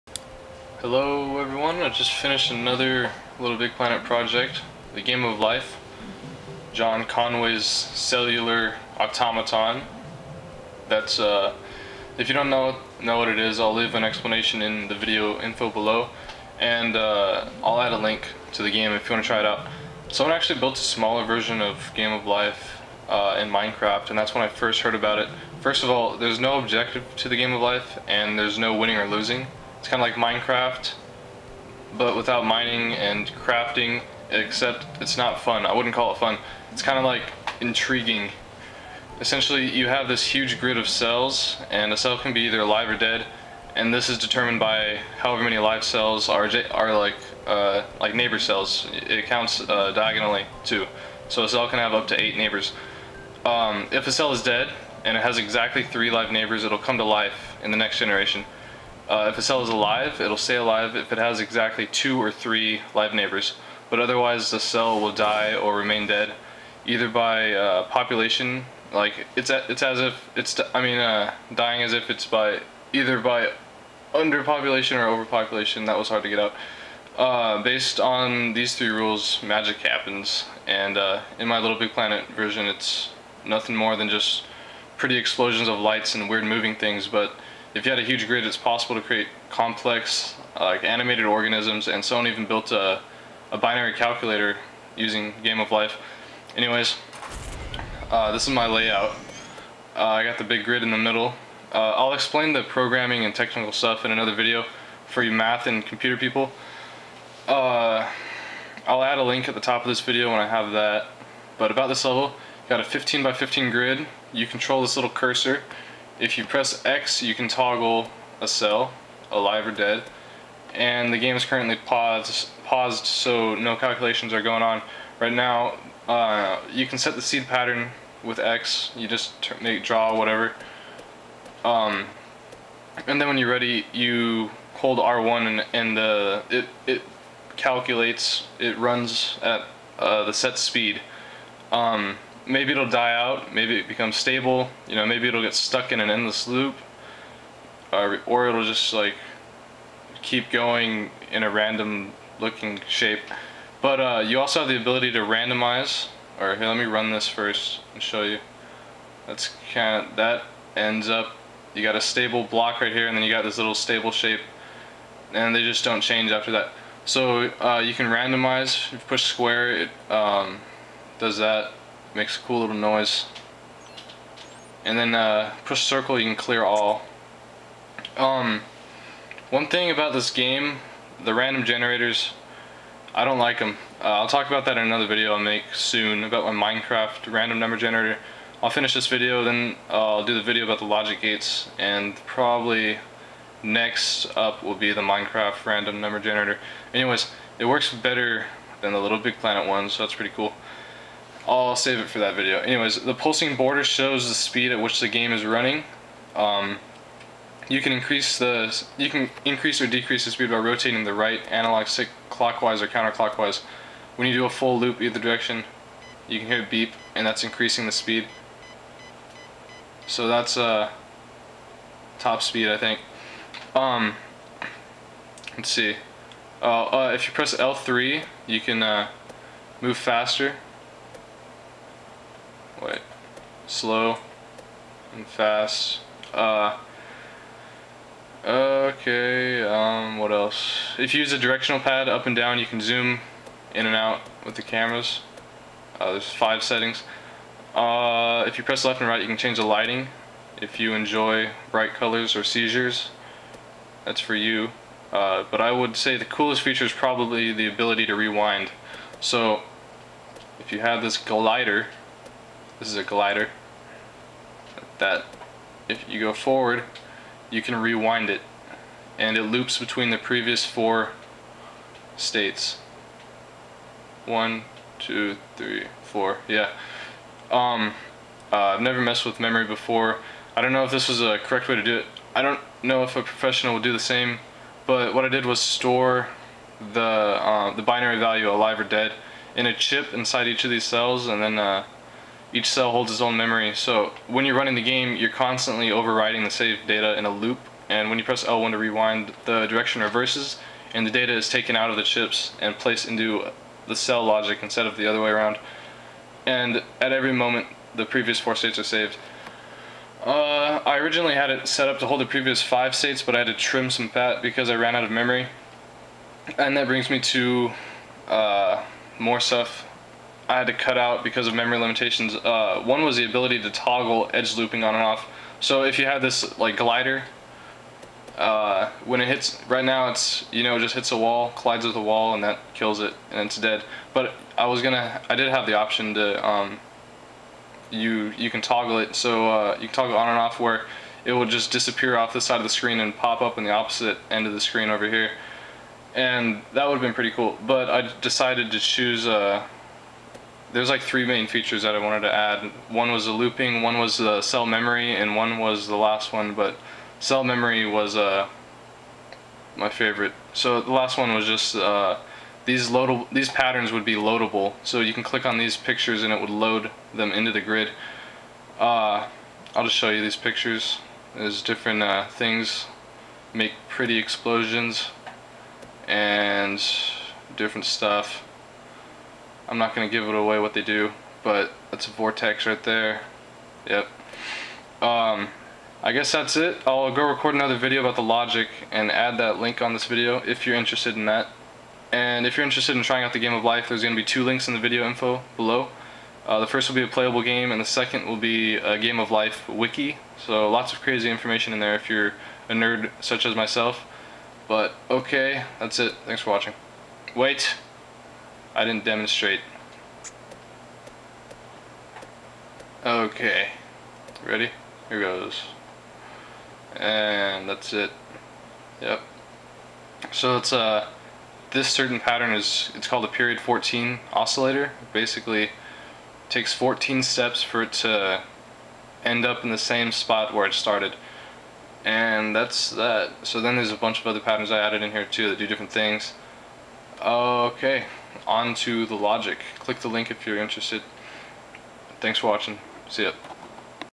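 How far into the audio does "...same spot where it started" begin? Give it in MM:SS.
07:09.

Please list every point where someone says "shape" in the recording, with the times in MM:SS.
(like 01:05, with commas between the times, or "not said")
02:32, 02:44.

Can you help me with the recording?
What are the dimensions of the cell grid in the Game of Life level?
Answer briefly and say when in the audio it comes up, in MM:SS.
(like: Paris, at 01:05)
15 by 15, at 01:52.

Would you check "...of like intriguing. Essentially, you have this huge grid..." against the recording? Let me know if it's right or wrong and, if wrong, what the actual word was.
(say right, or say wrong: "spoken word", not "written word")
right.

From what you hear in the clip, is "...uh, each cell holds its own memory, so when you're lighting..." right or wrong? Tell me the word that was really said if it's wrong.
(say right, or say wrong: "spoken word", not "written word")
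wrong: "running", not "lighting".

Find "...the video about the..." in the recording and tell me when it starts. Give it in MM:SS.
03:10.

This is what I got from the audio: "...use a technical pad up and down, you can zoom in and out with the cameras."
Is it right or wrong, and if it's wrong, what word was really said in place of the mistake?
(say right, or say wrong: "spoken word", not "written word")
wrong: "directional", not "technical".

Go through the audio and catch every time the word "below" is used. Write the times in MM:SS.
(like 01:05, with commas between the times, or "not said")
00:15, 06:35.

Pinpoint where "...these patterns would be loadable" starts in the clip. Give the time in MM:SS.
06:03.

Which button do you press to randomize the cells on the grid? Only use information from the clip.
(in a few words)
square.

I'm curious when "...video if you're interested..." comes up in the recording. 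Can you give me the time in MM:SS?
06:30.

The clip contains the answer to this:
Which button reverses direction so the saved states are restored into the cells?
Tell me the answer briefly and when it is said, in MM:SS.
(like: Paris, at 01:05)
L1, at 04:58.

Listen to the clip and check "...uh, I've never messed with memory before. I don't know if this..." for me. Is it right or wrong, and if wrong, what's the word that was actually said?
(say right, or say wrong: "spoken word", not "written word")
right.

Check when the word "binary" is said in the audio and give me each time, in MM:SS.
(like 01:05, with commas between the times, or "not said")
01:33, 04:47.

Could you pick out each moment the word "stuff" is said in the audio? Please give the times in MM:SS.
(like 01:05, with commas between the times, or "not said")
01:43, 05:19, 06:17.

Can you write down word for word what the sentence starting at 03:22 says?
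Anyways, the pulsing border shows the speed at which the game is running.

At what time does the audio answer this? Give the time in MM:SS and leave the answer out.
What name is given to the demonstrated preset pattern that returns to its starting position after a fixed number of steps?
07:03.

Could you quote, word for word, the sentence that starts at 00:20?
Someone actually built a smaller version of Game of Life uh, in Minecraft, and that's when I first heard about it.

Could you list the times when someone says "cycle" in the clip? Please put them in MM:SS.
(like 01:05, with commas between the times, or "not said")
not said.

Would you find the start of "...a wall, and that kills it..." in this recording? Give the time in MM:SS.
05:31.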